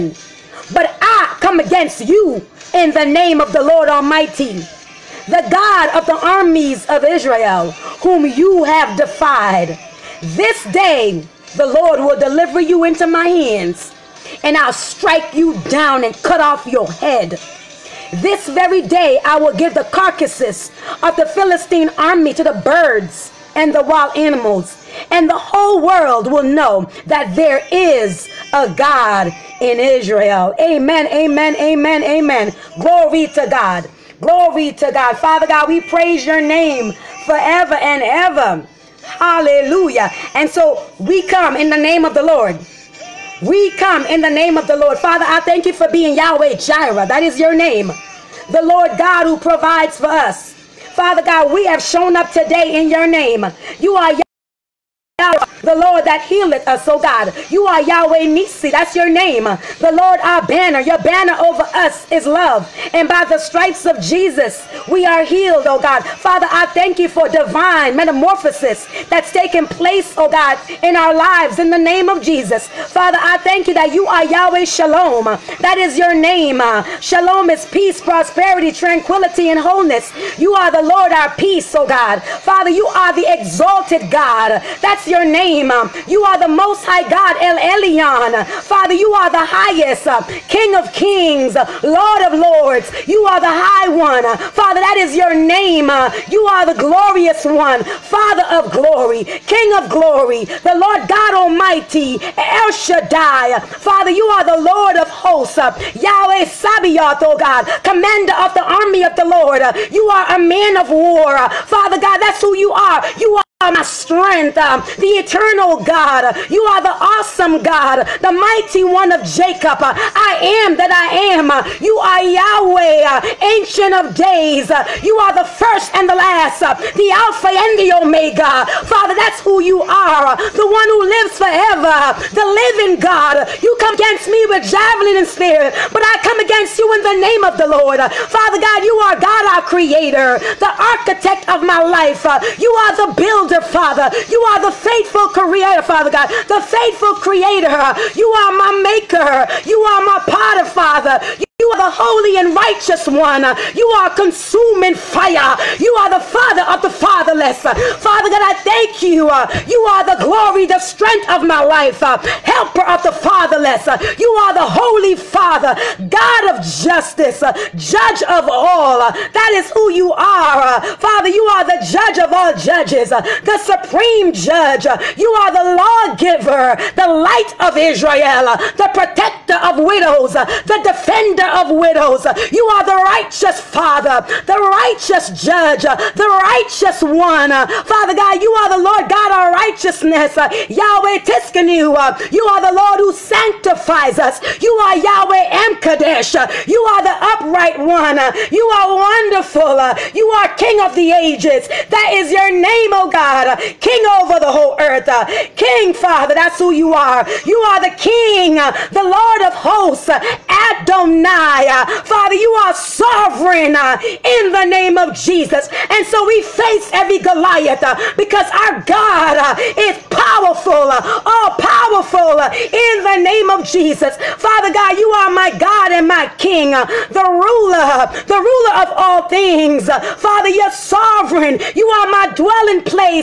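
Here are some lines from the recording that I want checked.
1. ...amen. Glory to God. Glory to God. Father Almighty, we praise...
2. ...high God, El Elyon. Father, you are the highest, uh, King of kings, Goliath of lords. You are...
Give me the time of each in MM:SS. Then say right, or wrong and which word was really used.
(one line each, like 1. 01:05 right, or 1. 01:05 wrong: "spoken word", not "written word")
1. 00:32 wrong: "God", not "Almighty"
2. 01:26 wrong: "Lord", not "Goliath".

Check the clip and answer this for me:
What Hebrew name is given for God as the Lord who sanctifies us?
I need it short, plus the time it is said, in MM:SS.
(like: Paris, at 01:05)
Yahweh M'Kaddesh, at 03:14.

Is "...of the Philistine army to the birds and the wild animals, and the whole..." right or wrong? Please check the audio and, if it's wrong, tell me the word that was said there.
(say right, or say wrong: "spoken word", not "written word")
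right.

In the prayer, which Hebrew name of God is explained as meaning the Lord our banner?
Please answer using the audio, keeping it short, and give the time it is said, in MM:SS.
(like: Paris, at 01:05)
Yahweh Nisi, at 00:57.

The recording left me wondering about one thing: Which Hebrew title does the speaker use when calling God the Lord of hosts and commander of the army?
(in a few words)
Yahweh Sabaoth.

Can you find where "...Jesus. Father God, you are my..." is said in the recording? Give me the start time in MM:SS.
03:43.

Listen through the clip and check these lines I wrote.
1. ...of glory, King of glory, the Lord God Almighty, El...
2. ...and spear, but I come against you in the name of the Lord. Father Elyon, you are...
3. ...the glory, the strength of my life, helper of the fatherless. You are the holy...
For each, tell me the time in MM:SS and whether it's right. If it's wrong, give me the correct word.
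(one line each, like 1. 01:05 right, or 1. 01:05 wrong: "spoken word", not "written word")
1. 01:38 right
2. 02:15 wrong: "God", not "Elyon"
3. 02:40 right.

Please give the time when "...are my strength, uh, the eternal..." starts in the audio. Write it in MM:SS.
01:53.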